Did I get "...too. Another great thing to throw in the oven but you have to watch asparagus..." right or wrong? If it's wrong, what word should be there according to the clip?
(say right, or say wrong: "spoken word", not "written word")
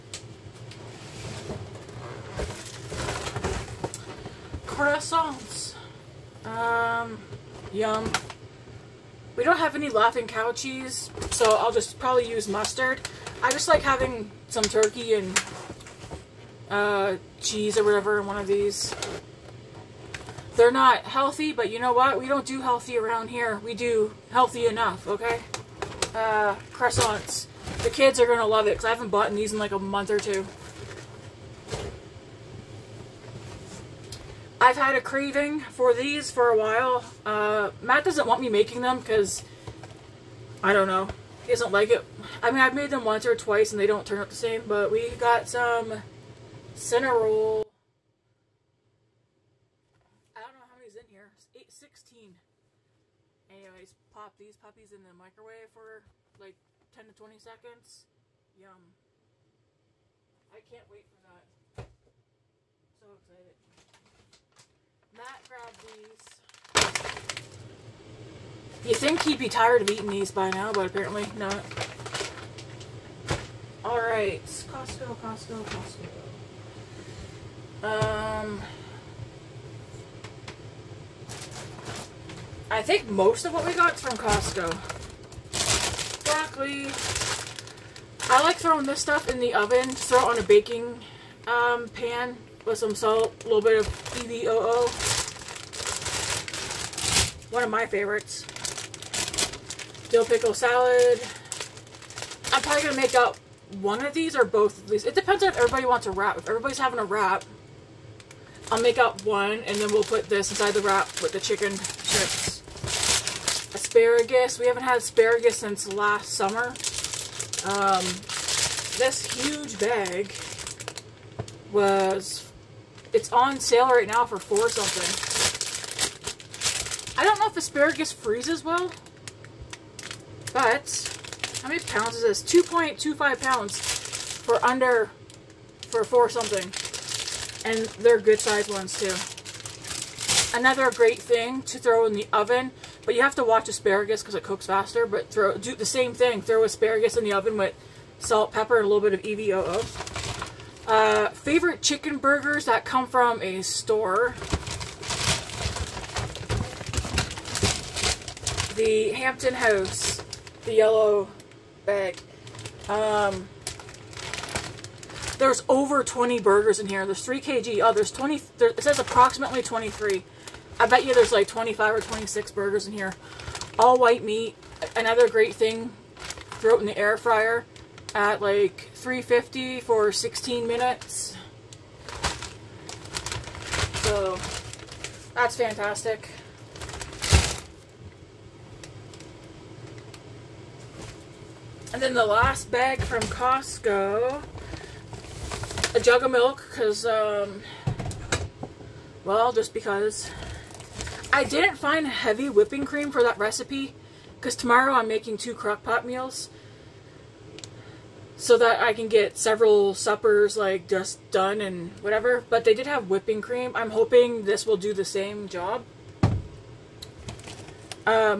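right.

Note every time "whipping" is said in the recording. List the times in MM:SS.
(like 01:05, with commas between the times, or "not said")
03:22, 03:33.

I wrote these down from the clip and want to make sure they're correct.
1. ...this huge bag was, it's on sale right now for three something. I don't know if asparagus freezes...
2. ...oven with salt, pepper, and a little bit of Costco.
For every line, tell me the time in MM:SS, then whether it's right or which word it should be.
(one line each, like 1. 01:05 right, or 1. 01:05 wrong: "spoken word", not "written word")
1. 01:58 wrong: "four", not "three"
2. 02:27 wrong: "EVOO", not "Costco".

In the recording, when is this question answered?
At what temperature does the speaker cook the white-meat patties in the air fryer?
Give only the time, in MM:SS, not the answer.
02:58.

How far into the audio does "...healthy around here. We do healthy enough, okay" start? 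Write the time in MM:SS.
00:22.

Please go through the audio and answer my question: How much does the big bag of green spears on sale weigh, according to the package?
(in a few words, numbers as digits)
2.25 pounds.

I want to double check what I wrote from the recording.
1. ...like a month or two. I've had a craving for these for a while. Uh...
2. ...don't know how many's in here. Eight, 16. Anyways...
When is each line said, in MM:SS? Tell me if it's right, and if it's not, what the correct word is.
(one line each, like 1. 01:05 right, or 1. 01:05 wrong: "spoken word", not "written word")
1. 00:29 right
2. 00:50 right.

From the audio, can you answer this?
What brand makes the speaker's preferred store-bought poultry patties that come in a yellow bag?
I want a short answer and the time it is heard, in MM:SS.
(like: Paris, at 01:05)
The Hampton House, at 02:38.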